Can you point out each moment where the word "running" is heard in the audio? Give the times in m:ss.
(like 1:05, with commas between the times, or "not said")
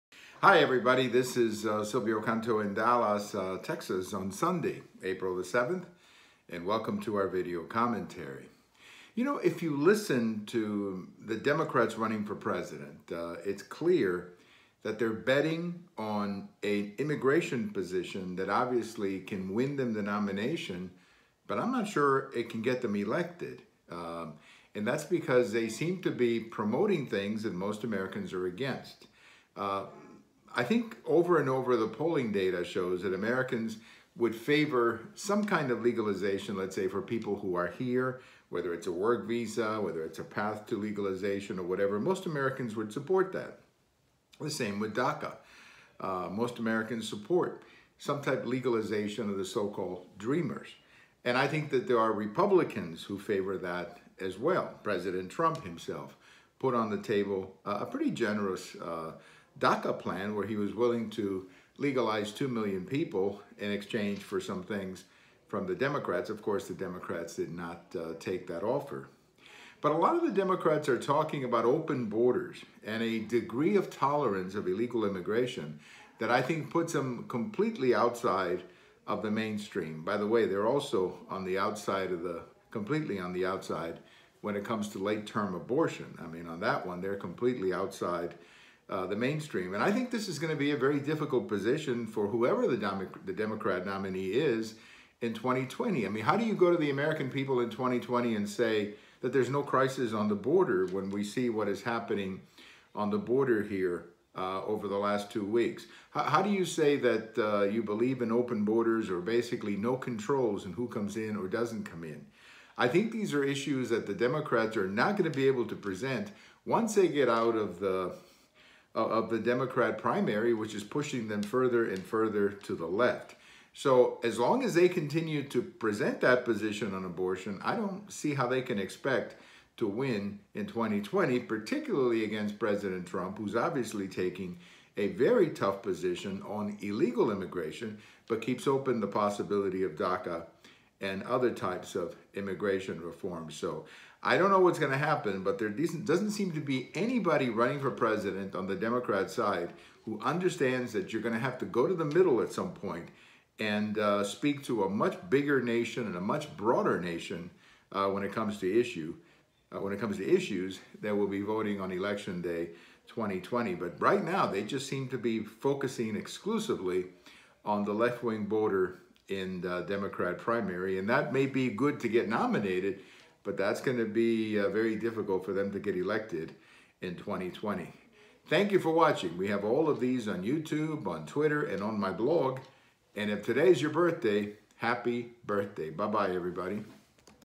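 0:11, 2:27.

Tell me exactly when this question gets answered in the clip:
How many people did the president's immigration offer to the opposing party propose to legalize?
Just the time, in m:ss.
1:02.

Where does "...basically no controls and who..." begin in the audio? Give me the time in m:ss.
1:49.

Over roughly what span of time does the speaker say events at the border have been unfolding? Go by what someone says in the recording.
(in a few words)
two weeks.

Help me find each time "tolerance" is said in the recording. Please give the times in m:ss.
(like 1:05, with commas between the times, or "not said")
1:13.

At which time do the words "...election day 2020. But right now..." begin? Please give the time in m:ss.
2:41.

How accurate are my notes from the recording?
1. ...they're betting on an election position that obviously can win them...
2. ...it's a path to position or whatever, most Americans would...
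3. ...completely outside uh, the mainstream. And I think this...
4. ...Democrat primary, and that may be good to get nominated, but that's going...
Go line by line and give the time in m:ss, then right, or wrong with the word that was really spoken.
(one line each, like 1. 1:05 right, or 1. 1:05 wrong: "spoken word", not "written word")
1. 0:14 wrong: "immigration", not "election"
2. 0:40 wrong: "legalization", not "position"
3. 1:27 right
4. 2:49 right.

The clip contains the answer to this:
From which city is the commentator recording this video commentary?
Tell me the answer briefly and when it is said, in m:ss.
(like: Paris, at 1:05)
Dallas, at 0:02.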